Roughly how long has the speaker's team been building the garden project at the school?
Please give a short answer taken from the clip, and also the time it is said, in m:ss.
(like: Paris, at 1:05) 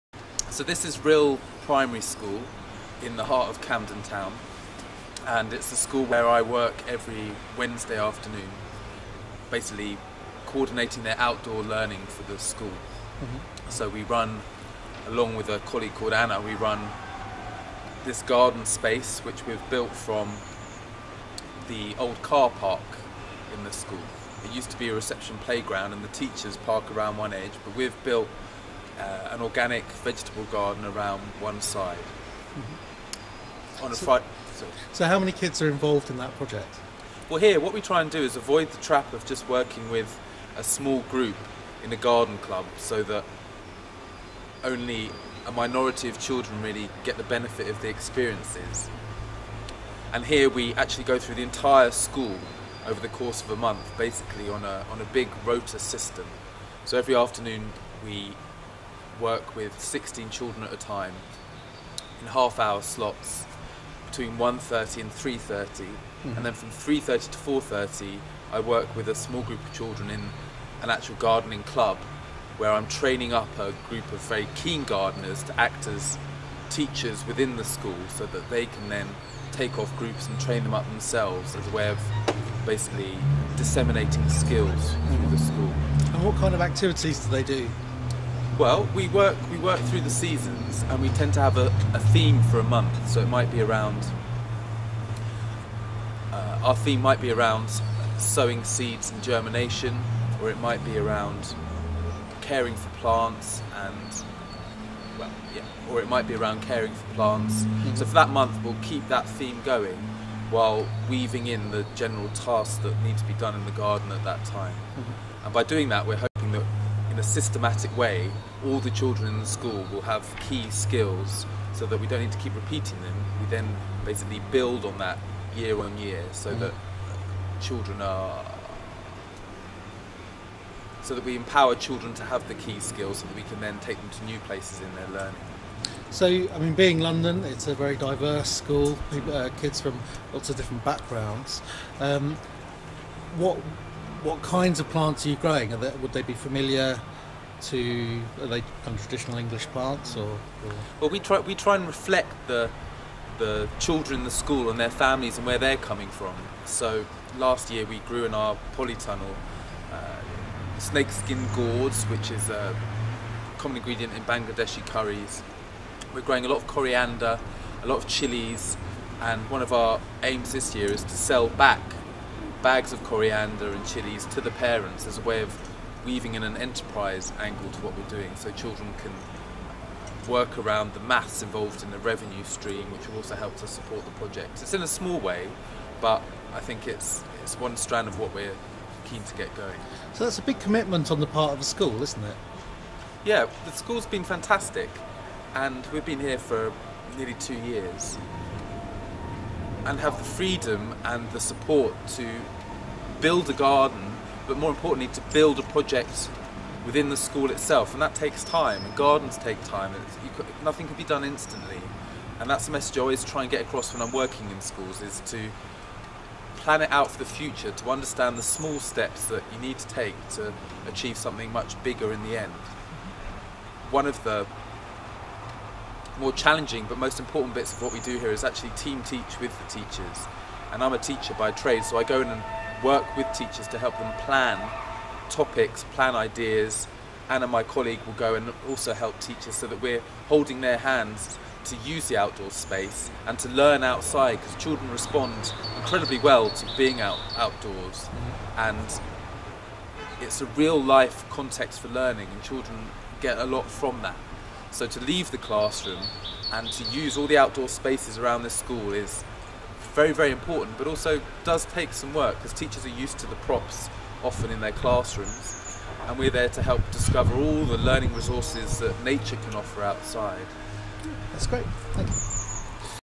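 Nearly two years, at 3:17.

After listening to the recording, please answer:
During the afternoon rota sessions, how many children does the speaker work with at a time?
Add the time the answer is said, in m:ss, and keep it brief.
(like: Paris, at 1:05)
16, at 0:59.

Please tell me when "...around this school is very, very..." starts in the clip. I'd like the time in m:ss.
4:18.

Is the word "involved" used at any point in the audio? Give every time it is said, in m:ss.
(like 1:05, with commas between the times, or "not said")
0:35, 3:01.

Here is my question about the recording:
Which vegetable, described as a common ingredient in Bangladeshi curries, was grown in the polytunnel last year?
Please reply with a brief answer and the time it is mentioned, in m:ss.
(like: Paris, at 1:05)
Snakeskin gourds, at 2:40.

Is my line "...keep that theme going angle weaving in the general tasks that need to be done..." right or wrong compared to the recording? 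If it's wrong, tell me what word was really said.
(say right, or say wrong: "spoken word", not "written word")
wrong: "while", not "angle".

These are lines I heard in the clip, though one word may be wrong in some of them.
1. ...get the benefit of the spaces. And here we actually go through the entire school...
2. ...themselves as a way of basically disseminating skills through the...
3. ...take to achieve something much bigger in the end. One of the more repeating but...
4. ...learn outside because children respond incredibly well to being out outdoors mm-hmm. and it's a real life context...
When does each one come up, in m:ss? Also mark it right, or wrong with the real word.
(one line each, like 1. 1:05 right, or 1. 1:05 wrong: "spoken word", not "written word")
1. 0:47 wrong: "experiences", not "spaces"
2. 1:20 right
3. 3:39 wrong: "challenging", not "repeating"
4. 4:03 right.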